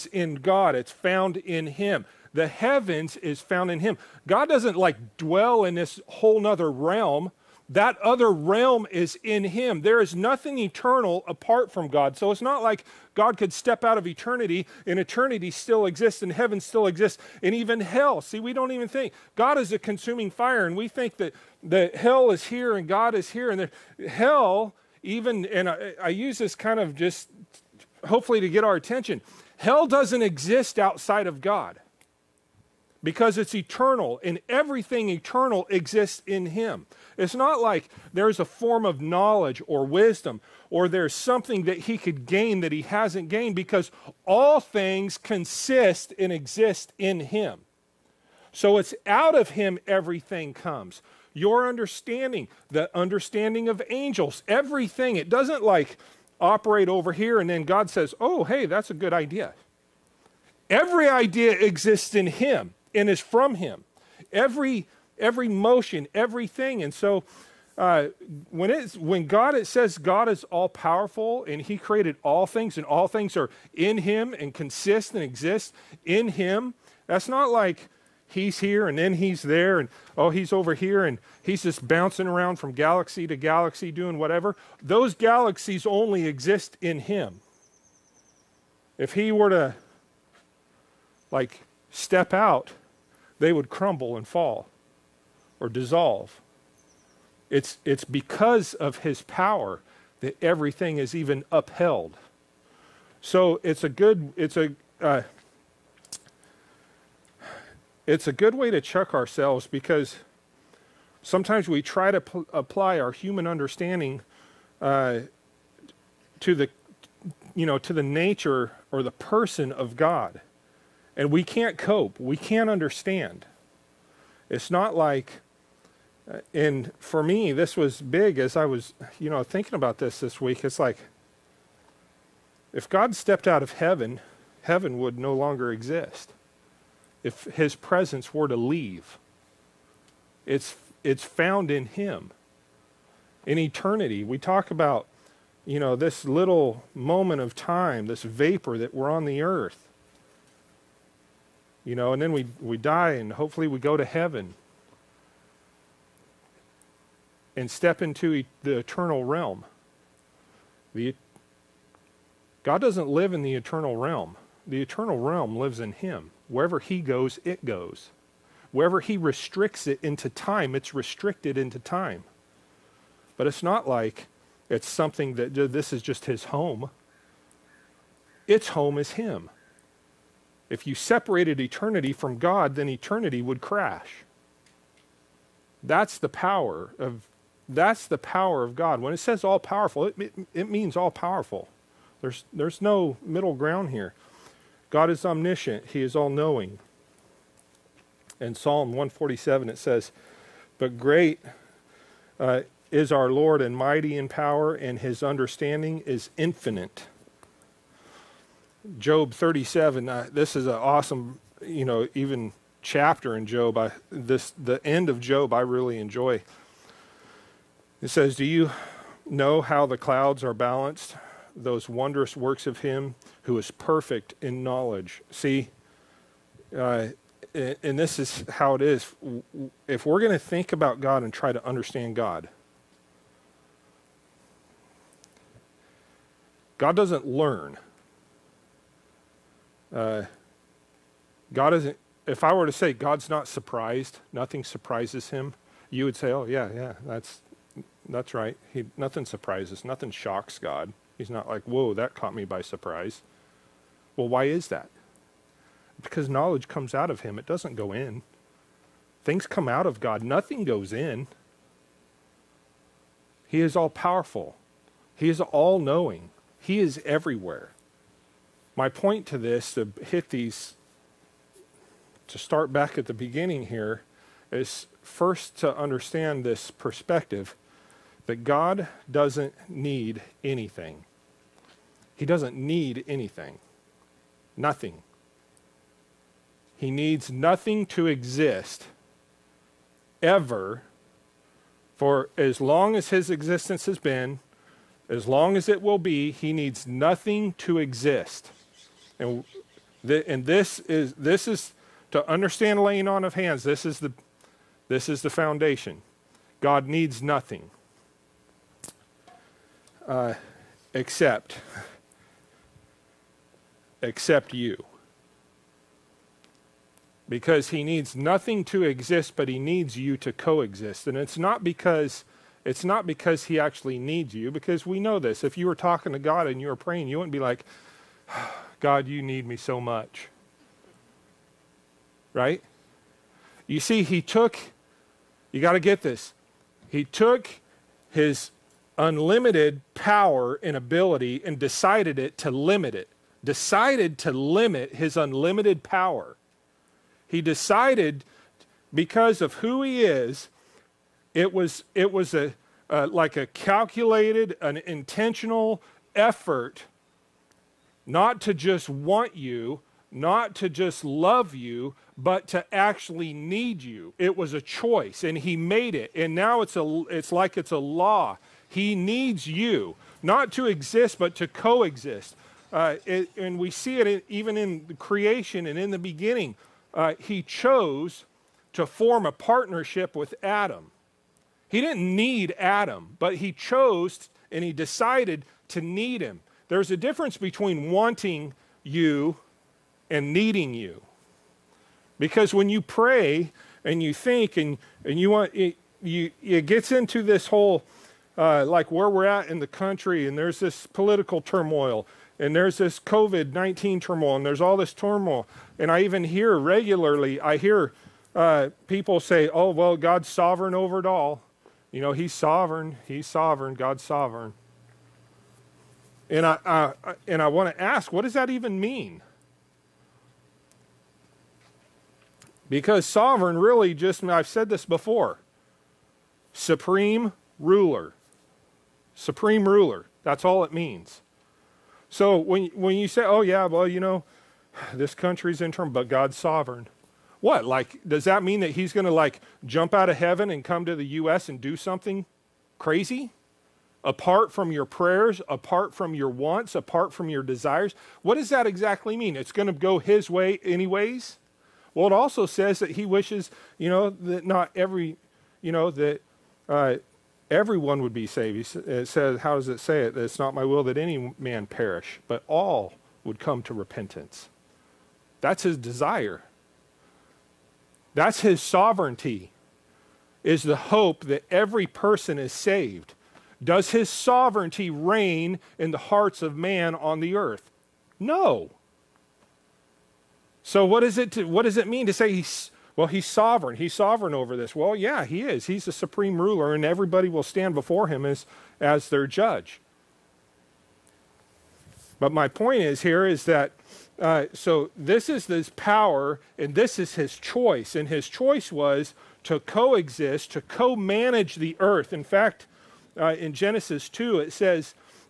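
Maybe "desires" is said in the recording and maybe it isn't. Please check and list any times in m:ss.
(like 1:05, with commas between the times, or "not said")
7:27, 7:45.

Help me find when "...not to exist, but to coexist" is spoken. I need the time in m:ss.
6:10.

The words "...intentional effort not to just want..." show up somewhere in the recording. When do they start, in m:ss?
5:54.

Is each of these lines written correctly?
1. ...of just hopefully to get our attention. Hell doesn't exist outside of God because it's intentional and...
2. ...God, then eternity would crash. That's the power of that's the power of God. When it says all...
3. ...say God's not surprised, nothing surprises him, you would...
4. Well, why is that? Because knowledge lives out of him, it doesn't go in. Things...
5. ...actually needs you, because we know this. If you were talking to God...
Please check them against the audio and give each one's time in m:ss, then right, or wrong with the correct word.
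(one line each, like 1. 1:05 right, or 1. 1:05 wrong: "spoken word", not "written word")
1. 0:26 wrong: "eternal", not "intentional"
2. 3:02 right
3. 4:02 right
4. 4:14 wrong: "comes", not "lives"
5. 5:23 right.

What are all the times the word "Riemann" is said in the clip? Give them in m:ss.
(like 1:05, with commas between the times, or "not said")
not said.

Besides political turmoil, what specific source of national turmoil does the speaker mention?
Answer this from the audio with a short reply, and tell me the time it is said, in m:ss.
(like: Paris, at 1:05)
COVID 19, at 6:42.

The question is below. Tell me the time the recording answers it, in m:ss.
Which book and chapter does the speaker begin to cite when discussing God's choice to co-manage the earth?
8:23.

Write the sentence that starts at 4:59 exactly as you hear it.
And, th and this, is, this is, to understand laying on of hands, this is the, this is the foundation.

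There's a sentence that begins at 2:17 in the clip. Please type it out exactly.
If his presence were to leave, it's, it's found in him.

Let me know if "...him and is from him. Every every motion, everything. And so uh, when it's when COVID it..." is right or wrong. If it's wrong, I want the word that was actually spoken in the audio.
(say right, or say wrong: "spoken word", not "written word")
wrong: "God", not "COVID".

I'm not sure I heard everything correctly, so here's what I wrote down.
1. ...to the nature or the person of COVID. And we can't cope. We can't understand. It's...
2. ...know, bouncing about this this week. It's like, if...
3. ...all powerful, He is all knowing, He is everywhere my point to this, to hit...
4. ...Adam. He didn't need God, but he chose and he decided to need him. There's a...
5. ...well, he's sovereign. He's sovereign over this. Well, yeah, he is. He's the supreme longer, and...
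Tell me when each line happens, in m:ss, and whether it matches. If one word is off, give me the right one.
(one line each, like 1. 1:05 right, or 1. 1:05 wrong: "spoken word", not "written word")
1. 1:57 wrong: "God", not "COVID"
2. 2:09 wrong: "thinking", not "bouncing"
3. 4:23 right
4. 6:20 wrong: "Adam", not "God"
5. 8:02 wrong: "ruler", not "longer".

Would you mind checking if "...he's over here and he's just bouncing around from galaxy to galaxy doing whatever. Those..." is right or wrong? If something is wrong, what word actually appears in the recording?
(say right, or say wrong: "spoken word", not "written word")
right.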